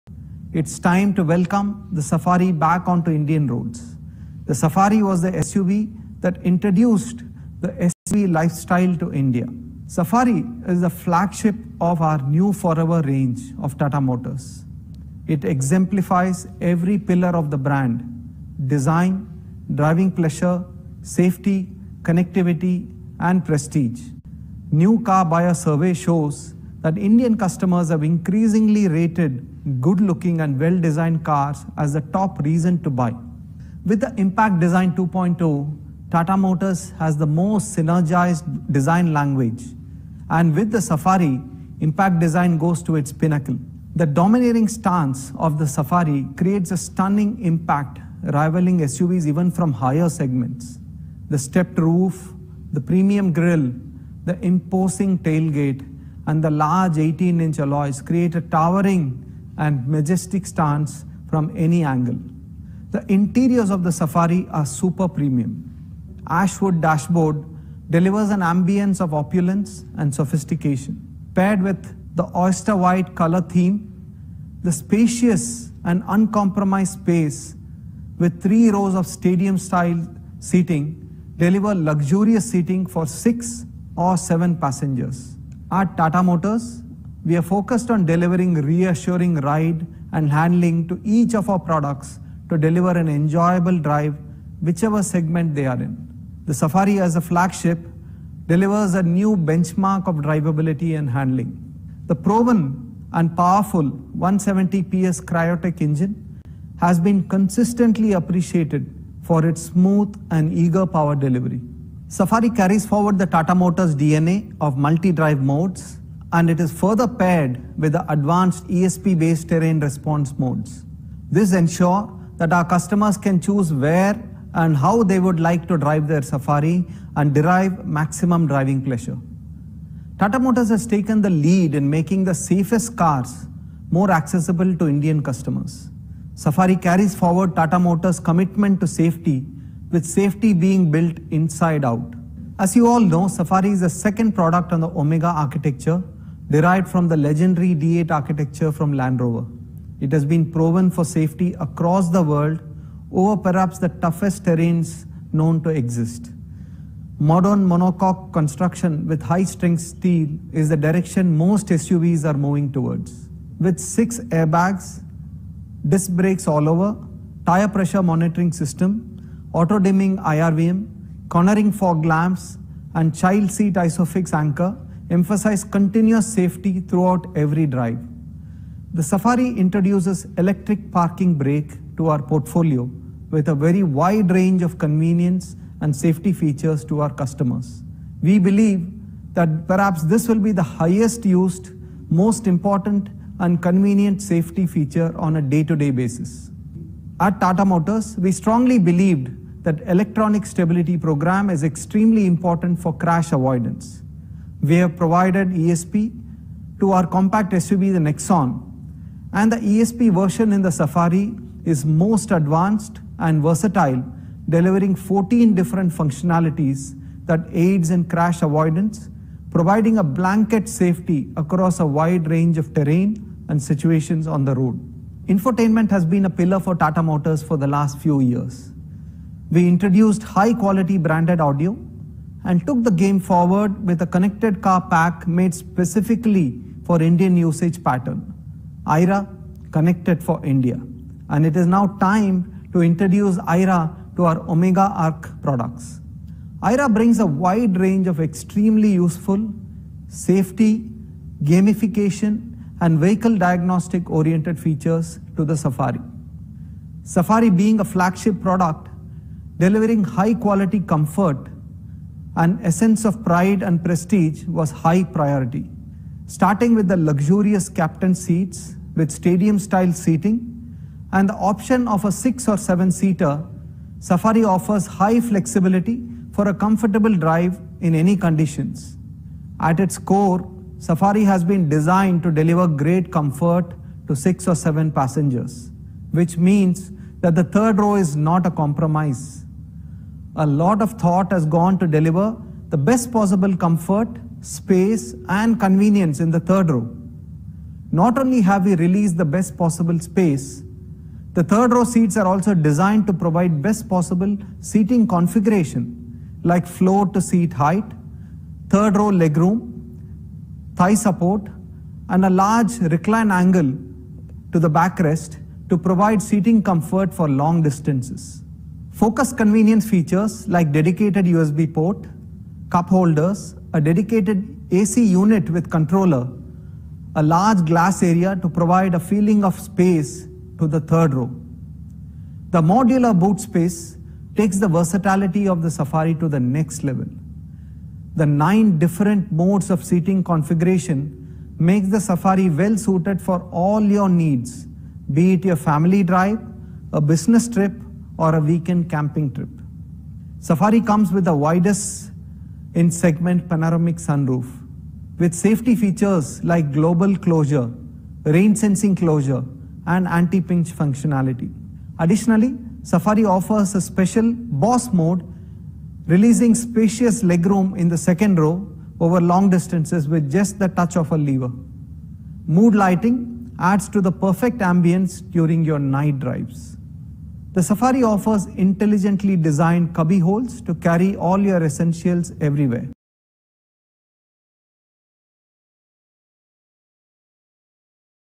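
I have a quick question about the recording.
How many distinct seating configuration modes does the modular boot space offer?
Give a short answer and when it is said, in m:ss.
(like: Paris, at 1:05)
9, at 5:38.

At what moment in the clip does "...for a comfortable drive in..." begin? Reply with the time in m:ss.
4:36.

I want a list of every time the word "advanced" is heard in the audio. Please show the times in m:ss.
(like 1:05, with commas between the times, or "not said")
1:58, 3:32.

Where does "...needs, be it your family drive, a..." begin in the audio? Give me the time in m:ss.
5:44.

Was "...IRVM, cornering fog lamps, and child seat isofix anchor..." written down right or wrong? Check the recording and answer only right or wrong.
right.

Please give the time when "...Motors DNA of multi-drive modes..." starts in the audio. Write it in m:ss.
1:53.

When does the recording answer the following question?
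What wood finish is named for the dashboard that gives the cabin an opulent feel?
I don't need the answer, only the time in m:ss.
1:06.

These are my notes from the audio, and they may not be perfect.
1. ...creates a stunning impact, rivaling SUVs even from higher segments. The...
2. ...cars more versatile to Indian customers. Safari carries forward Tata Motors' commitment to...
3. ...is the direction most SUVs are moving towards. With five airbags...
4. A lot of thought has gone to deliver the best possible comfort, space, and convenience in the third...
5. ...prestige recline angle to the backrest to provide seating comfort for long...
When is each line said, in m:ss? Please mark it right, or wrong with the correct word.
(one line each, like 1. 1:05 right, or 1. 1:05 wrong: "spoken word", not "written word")
1. 0:46 right
2. 2:12 wrong: "accessible", not "versatile"
3. 2:40 wrong: "six", not "five"
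4. 4:50 right
5. 5:12 wrong: "large", not "prestige".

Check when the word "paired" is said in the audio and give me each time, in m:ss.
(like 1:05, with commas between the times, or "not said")
1:11, 1:57.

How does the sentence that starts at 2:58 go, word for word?
The Safari introduces electric parking brake to our portfolio with a very wide range of convenience and safety features to our customers.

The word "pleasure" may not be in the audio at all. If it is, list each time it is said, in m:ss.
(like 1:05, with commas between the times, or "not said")
0:20, 2:08.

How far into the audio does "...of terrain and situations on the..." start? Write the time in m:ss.
3:42.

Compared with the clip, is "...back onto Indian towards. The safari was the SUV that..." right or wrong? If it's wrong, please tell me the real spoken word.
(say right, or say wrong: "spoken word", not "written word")
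wrong: "roads", not "towards".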